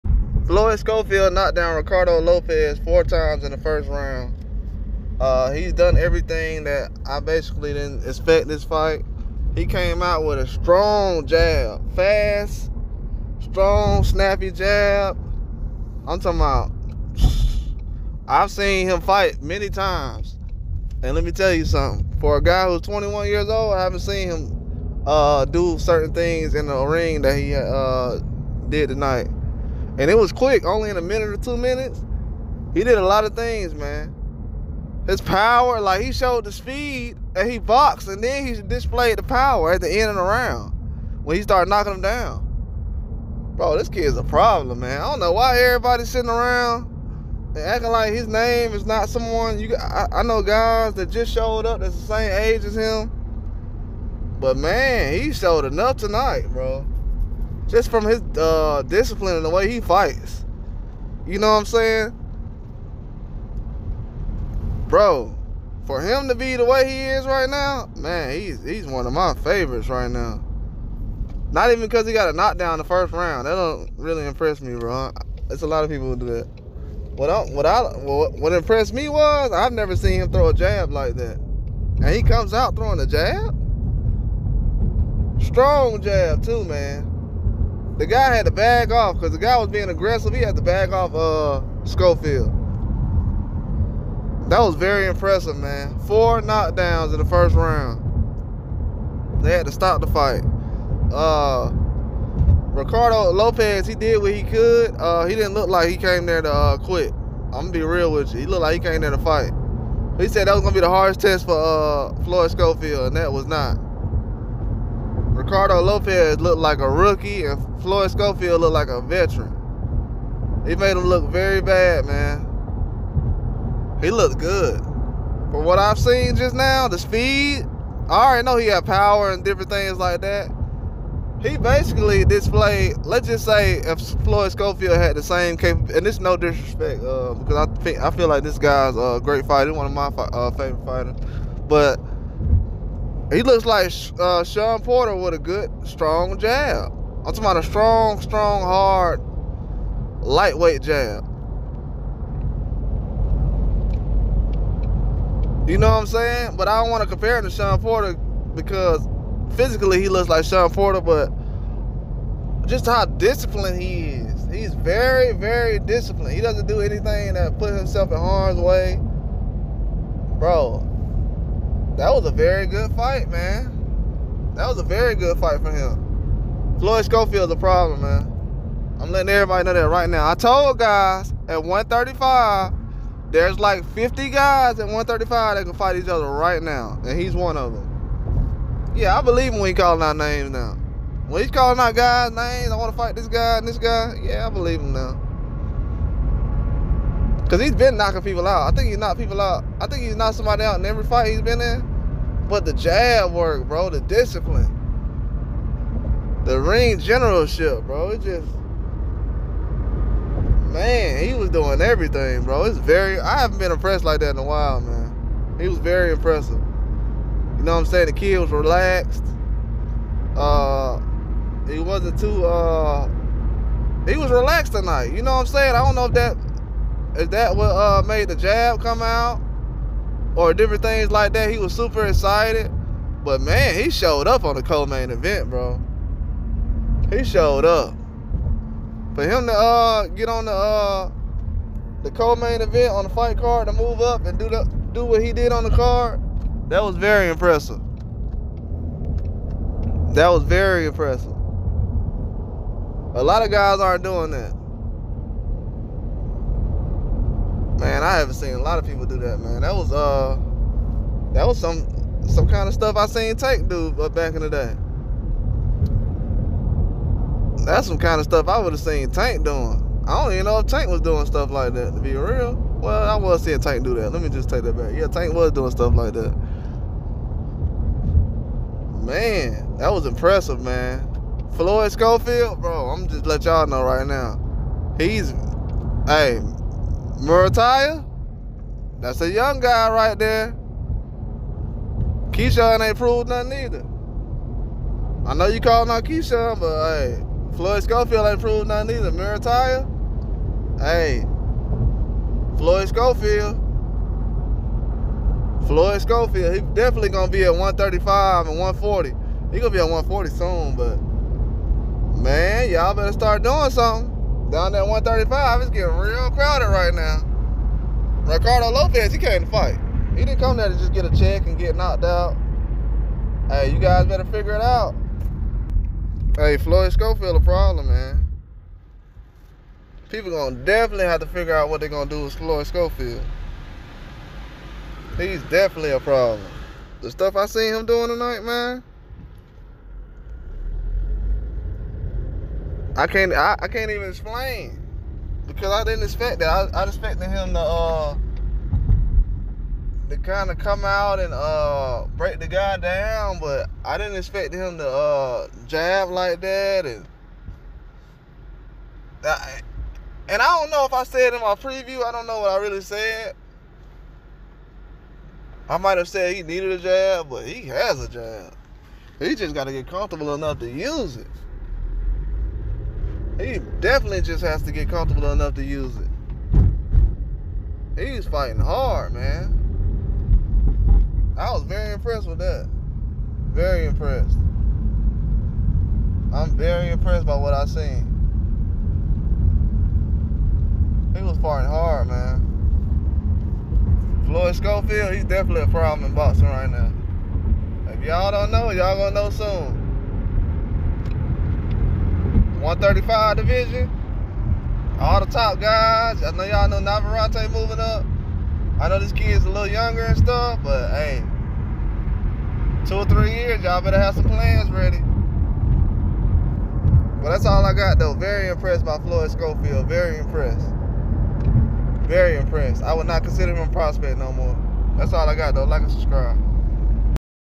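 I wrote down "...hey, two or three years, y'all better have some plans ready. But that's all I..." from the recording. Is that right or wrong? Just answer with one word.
right.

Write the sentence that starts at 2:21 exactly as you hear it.
But he looks like uh, Shawn Porter with a good, strong jab.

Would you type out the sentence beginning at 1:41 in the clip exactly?
Uh, Ricardo Lopez, he did what he could.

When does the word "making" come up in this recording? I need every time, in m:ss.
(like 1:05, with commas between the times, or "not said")
not said.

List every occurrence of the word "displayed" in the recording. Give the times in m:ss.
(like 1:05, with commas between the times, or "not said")
0:38, 2:12.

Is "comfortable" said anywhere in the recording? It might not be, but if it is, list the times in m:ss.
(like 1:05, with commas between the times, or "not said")
6:09, 6:14.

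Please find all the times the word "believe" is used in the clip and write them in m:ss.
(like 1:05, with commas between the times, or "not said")
3:09, 3:14.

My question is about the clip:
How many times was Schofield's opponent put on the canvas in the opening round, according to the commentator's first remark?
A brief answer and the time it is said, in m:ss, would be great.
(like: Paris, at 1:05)
4, at 0:02.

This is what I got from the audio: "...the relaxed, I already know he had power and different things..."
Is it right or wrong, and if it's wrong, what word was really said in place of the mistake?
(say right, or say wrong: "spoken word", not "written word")
wrong: "speed", not "relaxed".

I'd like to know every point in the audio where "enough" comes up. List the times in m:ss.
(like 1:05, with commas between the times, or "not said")
0:55, 6:10, 6:15.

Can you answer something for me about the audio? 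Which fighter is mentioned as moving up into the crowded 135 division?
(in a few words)
Navarrete.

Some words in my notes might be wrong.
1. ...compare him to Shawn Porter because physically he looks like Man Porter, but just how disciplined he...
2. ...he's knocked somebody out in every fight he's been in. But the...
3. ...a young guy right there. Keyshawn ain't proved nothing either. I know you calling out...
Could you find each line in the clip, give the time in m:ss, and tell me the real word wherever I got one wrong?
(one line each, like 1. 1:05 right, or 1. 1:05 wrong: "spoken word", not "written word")
1. 2:37 wrong: "Shawn", not "Man"
2. 3:20 right
3. 4:49 right.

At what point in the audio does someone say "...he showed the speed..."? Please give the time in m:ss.
0:36.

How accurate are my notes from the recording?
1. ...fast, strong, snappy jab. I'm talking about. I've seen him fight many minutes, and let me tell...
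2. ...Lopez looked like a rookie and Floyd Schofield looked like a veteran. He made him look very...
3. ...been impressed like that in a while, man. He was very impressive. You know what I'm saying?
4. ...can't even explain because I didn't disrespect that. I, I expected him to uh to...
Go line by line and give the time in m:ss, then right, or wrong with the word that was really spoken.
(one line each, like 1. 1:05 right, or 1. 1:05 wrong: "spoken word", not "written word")
1. 0:11 wrong: "times", not "minutes"
2. 1:55 right
3. 3:33 right
4. 5:43 wrong: "expect", not "disrespect".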